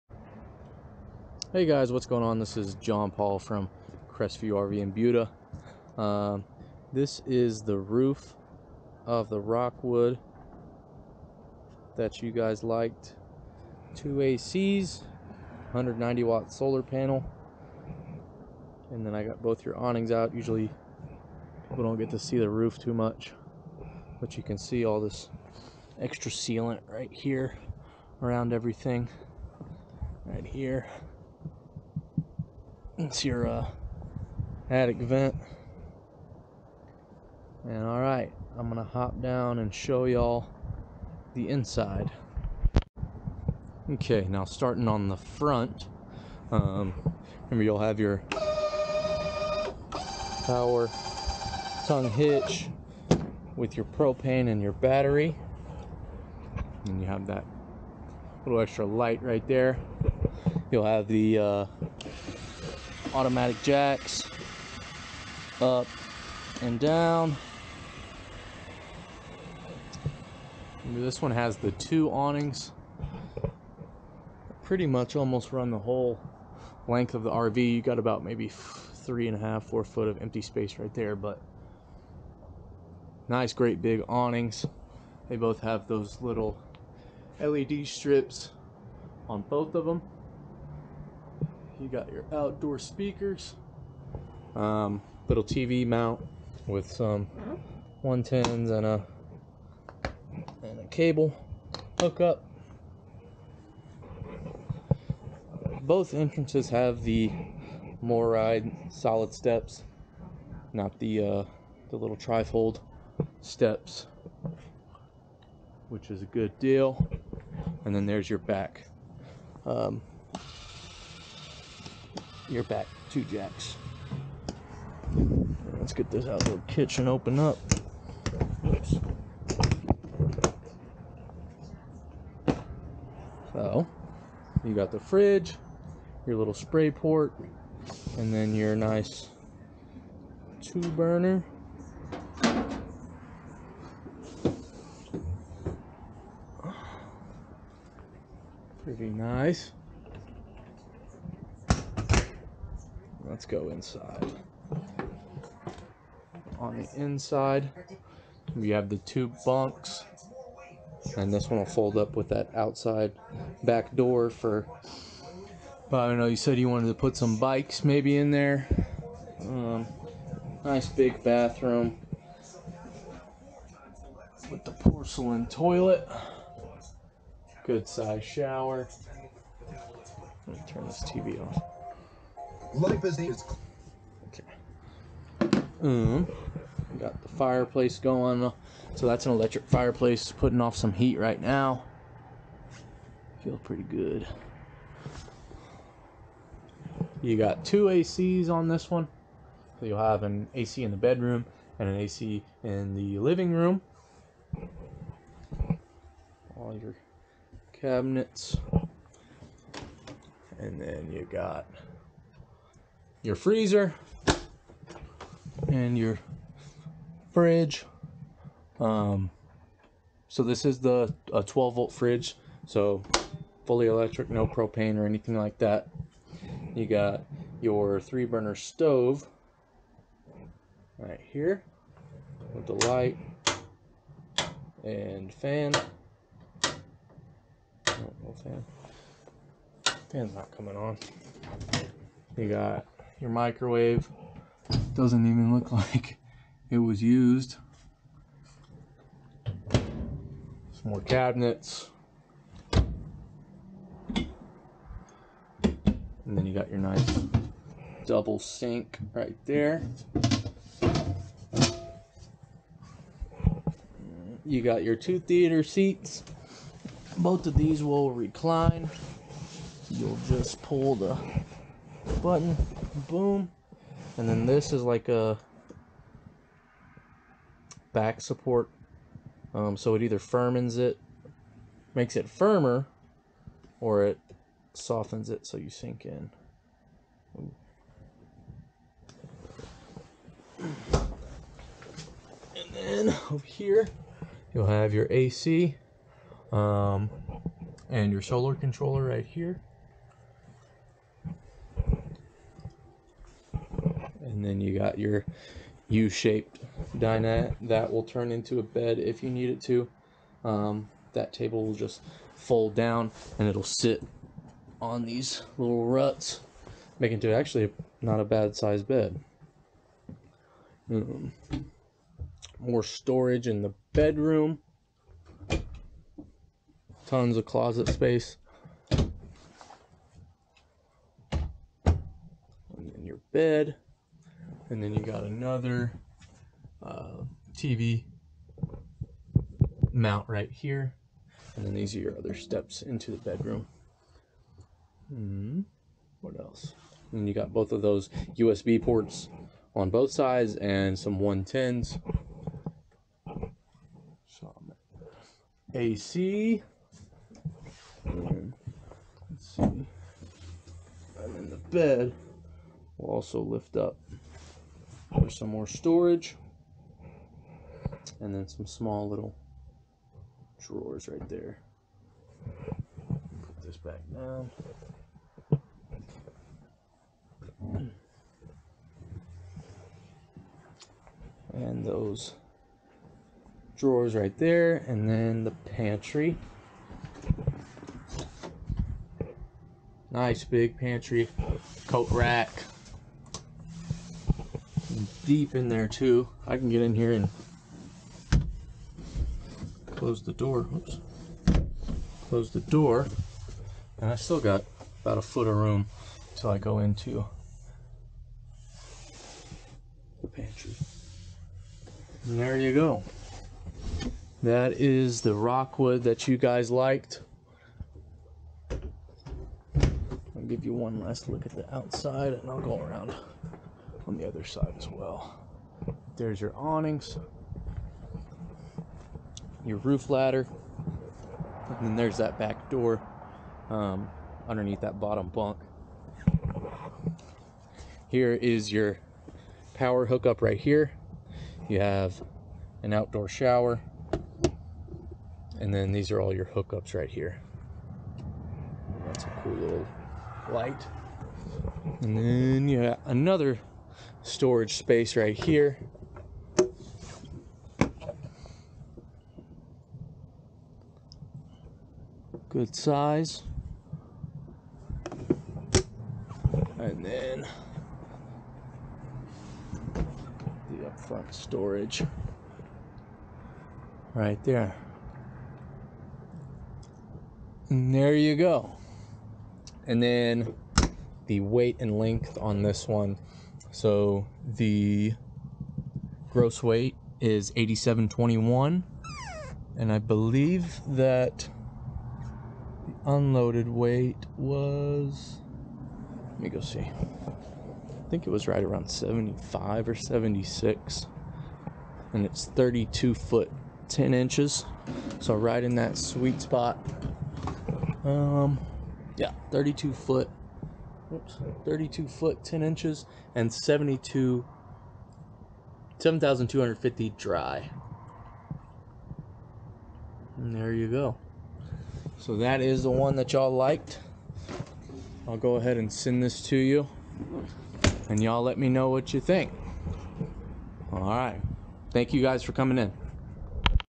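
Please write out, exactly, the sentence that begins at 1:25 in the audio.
They both have those little LED strips on both of them.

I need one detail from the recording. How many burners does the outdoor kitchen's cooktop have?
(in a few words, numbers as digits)
2.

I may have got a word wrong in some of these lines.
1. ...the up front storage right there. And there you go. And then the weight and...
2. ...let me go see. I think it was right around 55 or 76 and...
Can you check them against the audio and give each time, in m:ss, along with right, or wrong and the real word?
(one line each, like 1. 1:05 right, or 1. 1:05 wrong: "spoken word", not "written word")
1. 7:50 right
2. 8:16 wrong: "75", not "55".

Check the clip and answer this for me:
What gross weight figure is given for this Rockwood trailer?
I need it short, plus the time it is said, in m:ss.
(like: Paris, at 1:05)
8721, at 8:07.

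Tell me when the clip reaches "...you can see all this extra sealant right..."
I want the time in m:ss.
0:24.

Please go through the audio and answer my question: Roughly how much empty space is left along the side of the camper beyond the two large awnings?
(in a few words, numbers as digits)
3.5 to 4 feet.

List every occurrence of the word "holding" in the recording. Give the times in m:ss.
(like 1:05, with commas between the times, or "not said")
not said.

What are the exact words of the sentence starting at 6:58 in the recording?
I'll give you one last look at the outside and I'll go around on the other side as well.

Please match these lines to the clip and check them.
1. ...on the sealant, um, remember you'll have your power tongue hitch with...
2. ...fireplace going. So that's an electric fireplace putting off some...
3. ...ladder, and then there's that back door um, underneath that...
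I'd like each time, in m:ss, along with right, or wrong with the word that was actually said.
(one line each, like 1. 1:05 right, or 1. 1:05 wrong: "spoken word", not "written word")
1. 0:44 wrong: "front", not "sealant"
2. 3:07 right
3. 7:10 right.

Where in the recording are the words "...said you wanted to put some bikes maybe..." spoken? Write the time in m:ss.
2:46.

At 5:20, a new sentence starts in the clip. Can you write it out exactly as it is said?
Um, more storage in the bedroom.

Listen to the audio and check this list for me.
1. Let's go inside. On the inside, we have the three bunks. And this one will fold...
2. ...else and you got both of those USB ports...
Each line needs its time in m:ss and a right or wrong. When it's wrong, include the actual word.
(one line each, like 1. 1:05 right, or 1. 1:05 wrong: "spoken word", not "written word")
1. 2:33 wrong: "two", not "three"
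2. 5:46 right.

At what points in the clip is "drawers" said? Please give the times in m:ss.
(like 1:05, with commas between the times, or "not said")
6:10, 6:23.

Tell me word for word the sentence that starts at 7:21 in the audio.
You have an outdoor shower, and then these are all your hookups right here.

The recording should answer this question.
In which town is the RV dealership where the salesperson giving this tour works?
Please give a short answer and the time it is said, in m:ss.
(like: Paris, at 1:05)
Buda, at 0:04.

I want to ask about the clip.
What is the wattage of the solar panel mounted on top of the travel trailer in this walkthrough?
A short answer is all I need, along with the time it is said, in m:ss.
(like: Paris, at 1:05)
190 watt, at 0:15.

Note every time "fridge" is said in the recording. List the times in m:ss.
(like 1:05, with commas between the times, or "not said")
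2:14, 3:37, 3:41.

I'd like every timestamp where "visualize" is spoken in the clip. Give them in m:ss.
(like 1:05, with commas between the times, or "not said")
not said.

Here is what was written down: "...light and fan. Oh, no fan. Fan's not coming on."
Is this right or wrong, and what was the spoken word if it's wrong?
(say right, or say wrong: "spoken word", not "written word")
right.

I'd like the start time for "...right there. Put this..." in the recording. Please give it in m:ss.
6:11.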